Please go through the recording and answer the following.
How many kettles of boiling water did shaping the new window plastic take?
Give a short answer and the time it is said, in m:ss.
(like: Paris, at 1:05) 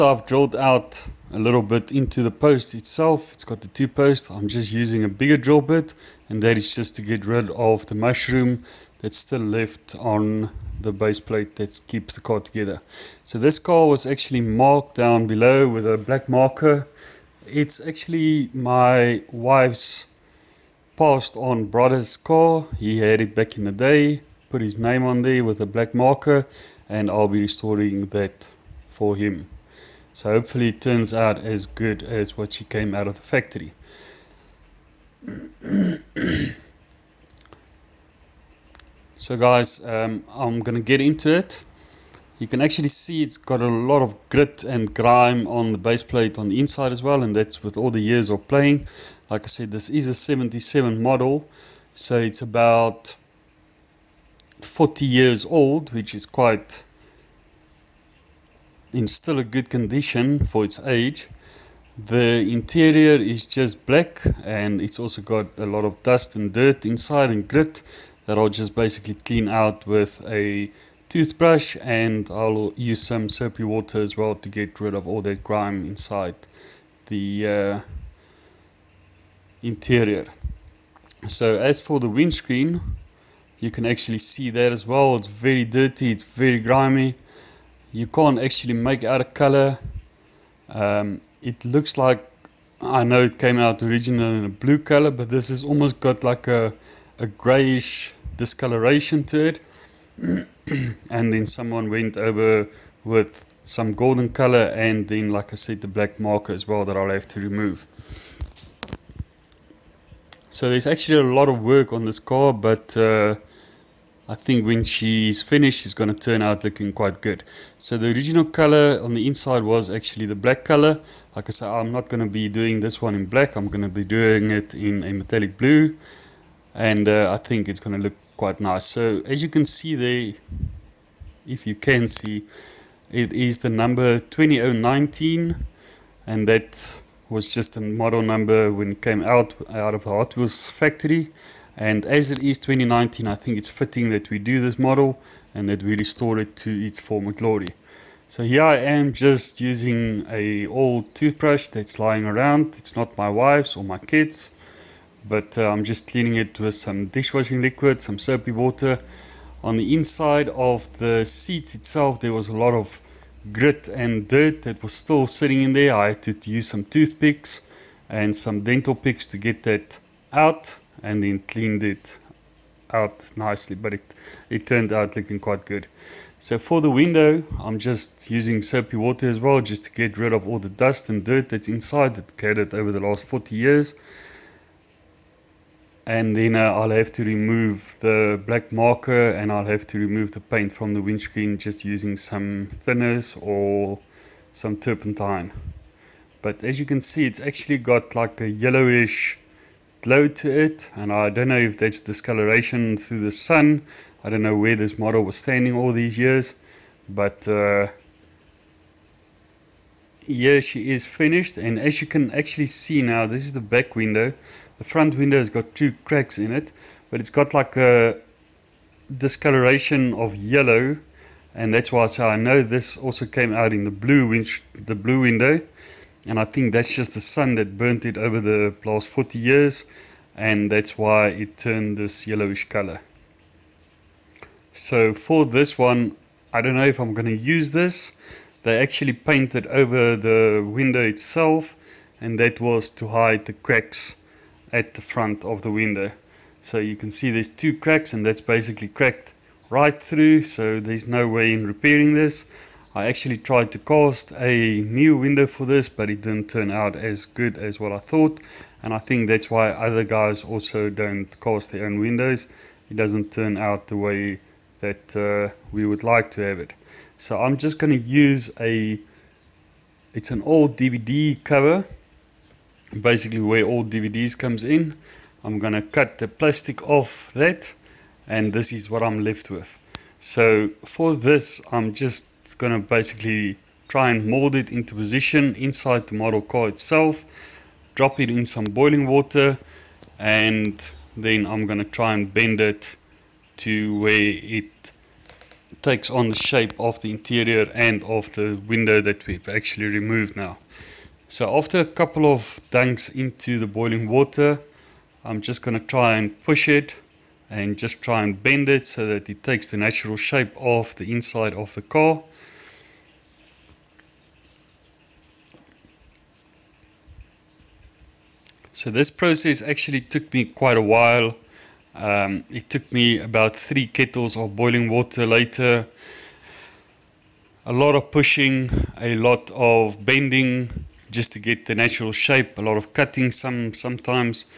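3, at 5:23.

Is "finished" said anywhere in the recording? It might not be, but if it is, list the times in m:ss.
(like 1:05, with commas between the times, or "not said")
1:55, 3:31.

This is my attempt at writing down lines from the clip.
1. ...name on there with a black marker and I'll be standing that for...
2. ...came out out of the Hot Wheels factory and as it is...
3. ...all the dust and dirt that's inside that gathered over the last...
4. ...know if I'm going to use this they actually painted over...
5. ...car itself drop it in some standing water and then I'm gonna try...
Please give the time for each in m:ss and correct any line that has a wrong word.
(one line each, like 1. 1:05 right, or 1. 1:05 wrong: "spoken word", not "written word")
1. 0:24 wrong: "restoring", not "standing"
2. 2:19 right
3. 3:00 right
4. 3:56 right
5. 4:46 wrong: "boiling", not "standing".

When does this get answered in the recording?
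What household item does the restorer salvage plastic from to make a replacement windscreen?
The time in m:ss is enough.
4:30.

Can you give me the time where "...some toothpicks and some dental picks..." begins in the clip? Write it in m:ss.
2:46.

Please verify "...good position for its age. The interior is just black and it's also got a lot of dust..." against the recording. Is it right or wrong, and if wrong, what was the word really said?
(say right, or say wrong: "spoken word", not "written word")
wrong: "condition", not "position".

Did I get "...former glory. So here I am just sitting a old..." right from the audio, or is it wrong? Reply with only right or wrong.
wrong.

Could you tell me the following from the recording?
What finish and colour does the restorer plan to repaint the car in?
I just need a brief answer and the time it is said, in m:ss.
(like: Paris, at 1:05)
metallic blue, at 2:05.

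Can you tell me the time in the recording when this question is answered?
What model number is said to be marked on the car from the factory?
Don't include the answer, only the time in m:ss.
2:14.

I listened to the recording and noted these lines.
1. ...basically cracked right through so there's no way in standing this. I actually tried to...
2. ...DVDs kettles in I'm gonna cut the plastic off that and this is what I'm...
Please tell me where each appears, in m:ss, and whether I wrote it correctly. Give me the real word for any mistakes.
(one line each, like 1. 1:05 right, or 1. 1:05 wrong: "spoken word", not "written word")
1. 4:08 wrong: "repairing", not "standing"
2. 4:33 wrong: "comes", not "kettles".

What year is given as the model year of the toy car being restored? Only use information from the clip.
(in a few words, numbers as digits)
1977.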